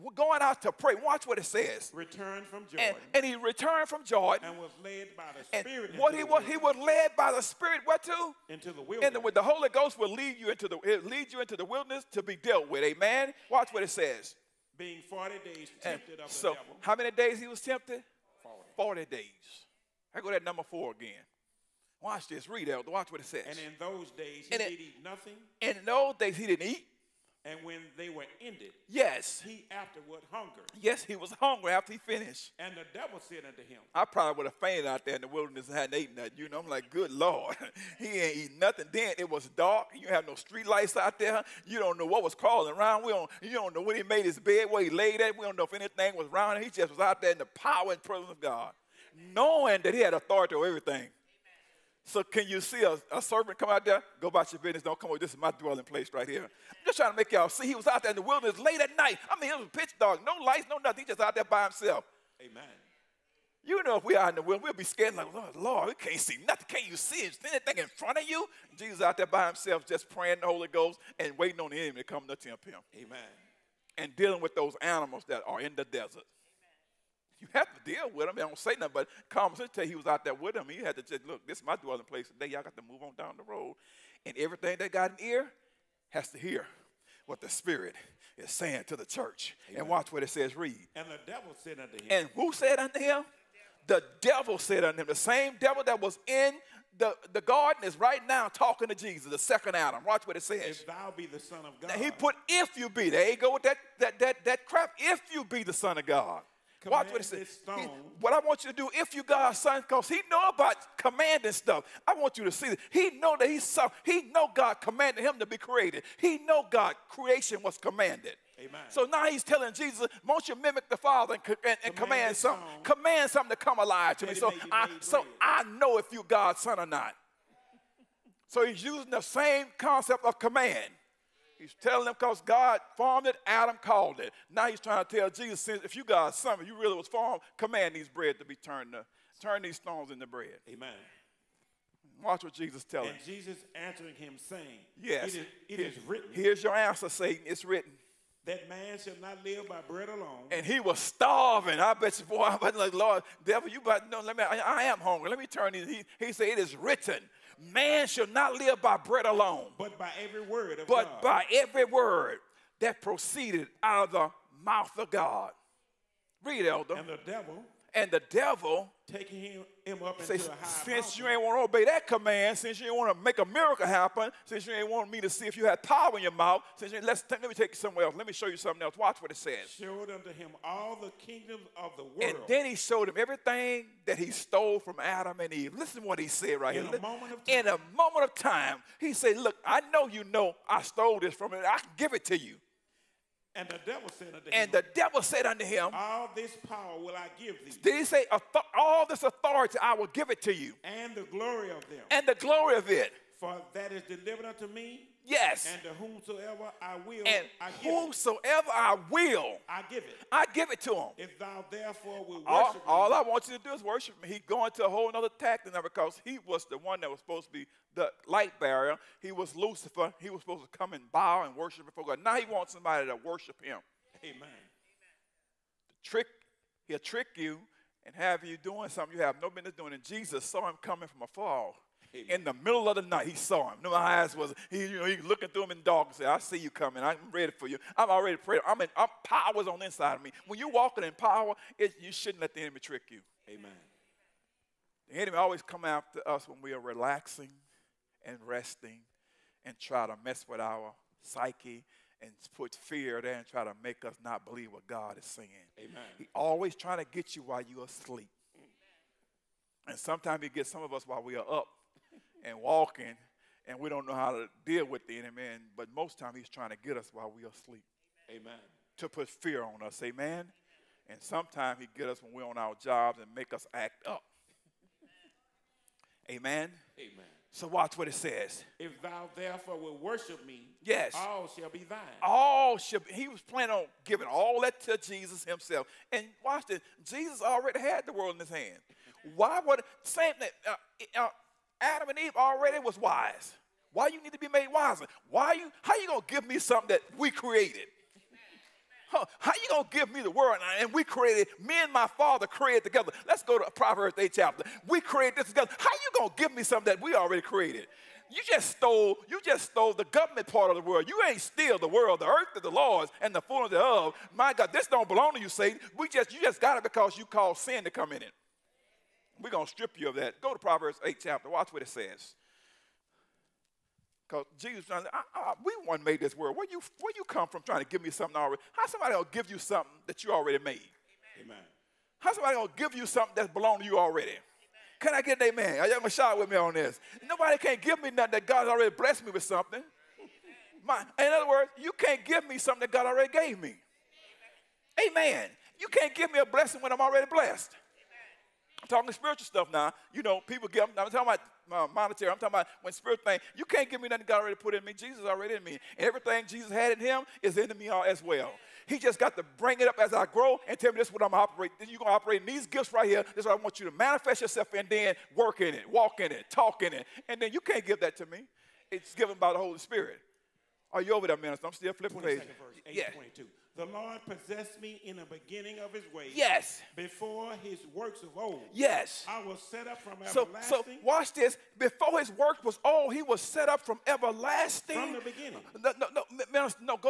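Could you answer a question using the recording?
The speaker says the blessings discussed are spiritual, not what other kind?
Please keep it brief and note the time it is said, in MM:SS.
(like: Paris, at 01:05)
monetary, at 05:51.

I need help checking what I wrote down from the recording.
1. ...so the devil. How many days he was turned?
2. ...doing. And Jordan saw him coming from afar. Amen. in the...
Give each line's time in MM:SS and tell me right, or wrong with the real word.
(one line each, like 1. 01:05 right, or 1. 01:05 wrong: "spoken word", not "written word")
1. 00:16 wrong: "tempted", not "turned"
2. 03:49 wrong: "Jesus", not "Jordan".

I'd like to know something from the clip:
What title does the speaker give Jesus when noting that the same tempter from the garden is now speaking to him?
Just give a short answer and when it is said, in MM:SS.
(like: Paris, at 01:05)
the second Adam, at 01:39.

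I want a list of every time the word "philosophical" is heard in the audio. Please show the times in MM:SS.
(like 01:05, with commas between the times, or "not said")
not said.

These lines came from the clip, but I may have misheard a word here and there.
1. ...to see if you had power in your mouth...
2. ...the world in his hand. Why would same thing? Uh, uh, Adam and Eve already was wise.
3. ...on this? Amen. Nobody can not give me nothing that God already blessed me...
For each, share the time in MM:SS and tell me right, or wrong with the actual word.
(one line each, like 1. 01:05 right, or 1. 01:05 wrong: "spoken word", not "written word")
1. 02:55 right
2. 04:48 right
3. 05:36 right.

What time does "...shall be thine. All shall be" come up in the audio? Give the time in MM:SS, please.
04:41.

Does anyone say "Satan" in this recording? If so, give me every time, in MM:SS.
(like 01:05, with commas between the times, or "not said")
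02:27, 05:15.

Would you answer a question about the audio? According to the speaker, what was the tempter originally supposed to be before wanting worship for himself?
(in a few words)
the light bearer.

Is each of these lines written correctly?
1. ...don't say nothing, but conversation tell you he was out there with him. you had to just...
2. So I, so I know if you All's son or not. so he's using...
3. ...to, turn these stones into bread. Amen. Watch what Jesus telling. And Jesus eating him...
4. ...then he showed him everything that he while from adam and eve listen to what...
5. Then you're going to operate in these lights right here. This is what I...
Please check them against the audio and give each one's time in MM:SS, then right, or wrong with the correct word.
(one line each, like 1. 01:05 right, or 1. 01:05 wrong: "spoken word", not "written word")
1. 01:18 right
2. 02:04 wrong: "God", not "All"
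3. 02:18 wrong: "answering", not "eating"
4. 03:02 wrong: "stole", not "while"
5. 06:01 wrong: "gifts", not "lights".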